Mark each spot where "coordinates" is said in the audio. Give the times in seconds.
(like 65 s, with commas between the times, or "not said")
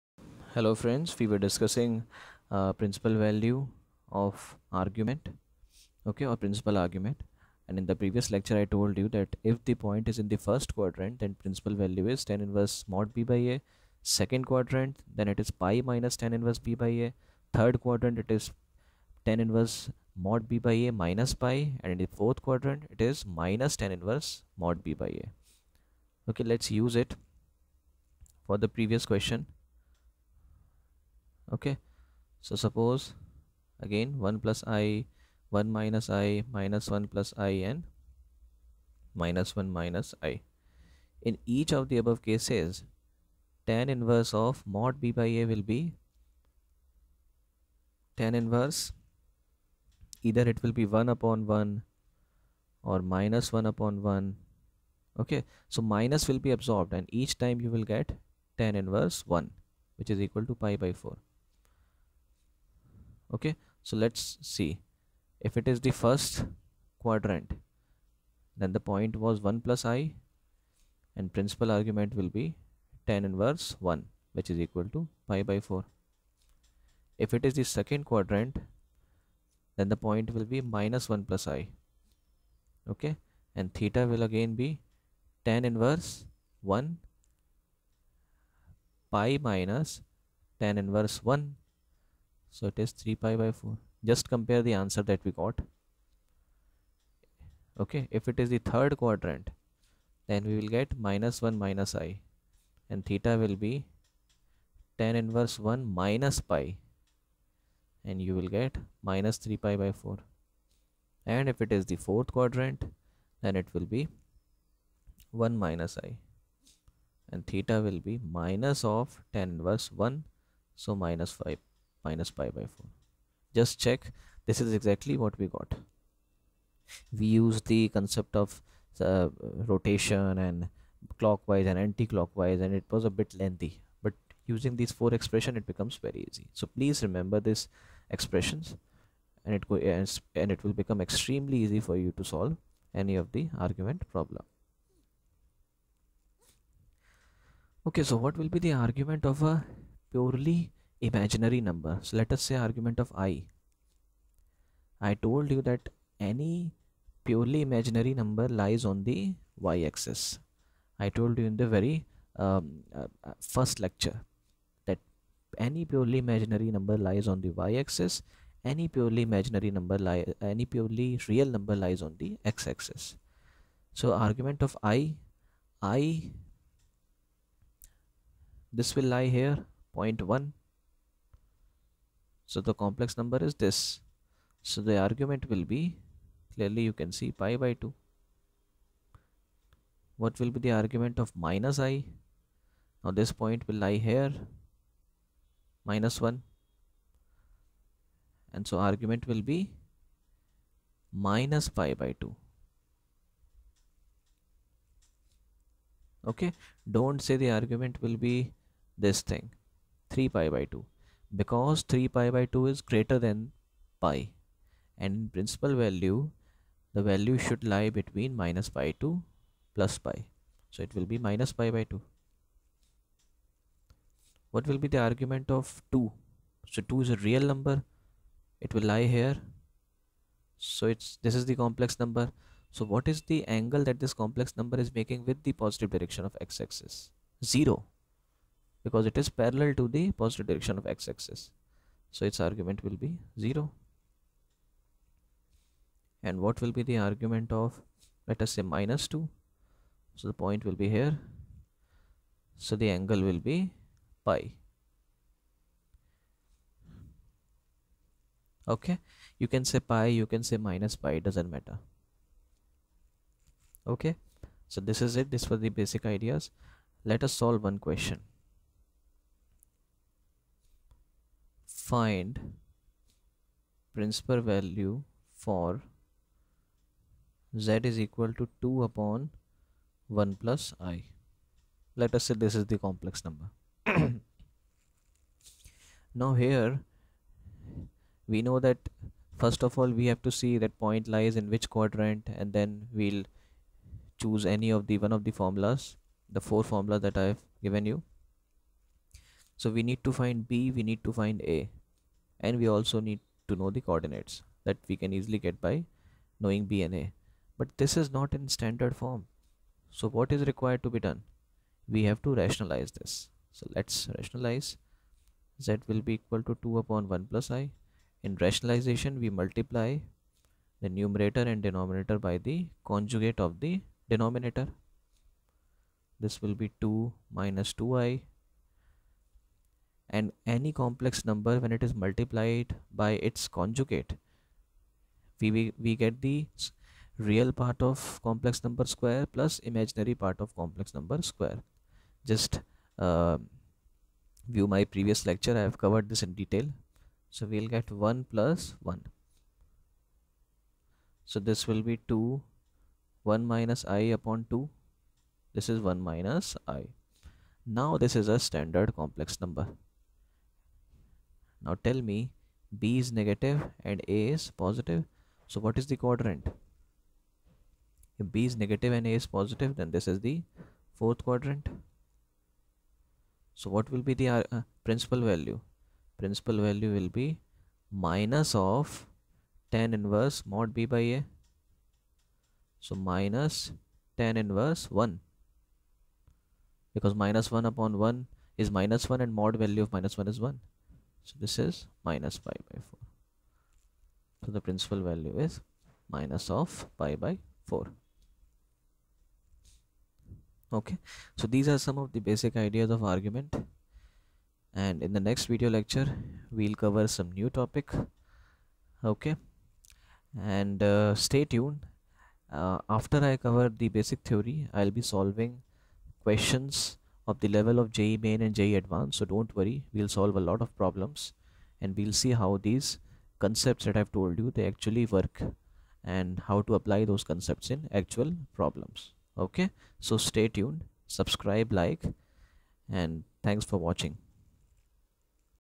303 s.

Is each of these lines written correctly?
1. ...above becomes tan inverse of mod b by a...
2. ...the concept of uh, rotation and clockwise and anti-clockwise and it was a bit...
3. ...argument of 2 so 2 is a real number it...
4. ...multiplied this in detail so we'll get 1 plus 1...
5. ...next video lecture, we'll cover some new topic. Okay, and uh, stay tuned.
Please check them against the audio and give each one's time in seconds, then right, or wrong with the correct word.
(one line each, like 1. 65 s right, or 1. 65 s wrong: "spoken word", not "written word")
1. 42 s wrong: "cases", not "becomes"
2. 127 s right
3. 225 s right
4. 345 s wrong: "covered", not "multiplied"
5. 405 s right.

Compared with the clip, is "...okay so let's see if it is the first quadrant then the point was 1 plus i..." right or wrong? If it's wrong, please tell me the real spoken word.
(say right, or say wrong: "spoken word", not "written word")
right.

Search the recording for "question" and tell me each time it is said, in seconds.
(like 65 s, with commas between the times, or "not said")
29 s, 267 s, 416 s.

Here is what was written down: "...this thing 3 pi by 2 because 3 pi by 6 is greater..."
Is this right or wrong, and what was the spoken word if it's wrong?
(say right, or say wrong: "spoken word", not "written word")
wrong: "2", not "6".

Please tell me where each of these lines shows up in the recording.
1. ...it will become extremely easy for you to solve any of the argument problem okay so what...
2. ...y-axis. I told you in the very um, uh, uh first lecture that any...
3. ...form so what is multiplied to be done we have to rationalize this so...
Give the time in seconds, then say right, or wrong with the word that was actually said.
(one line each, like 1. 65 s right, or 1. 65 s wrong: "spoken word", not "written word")
1. 140 s right
2. 159 s right
3. 309 s wrong: "required", not "multiplied".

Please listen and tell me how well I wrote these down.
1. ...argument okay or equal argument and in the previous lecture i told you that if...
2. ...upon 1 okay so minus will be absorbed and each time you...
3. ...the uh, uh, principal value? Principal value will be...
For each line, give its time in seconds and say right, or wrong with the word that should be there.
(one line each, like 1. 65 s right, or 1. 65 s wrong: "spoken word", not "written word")
1. 4 s wrong: "principal", not "equal"
2. 53 s right
3. 374 s right.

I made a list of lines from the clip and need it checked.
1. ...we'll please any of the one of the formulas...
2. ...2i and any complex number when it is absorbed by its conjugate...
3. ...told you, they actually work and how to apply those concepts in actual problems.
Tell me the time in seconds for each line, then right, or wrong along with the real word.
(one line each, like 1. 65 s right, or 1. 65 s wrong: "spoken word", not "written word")
1. 293 s wrong: "choose", not "please"
2. 327 s wrong: "multiplied", not "absorbed"
3. 424 s right.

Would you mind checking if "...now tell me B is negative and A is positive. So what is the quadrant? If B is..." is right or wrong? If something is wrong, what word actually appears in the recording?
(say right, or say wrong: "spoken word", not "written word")
right.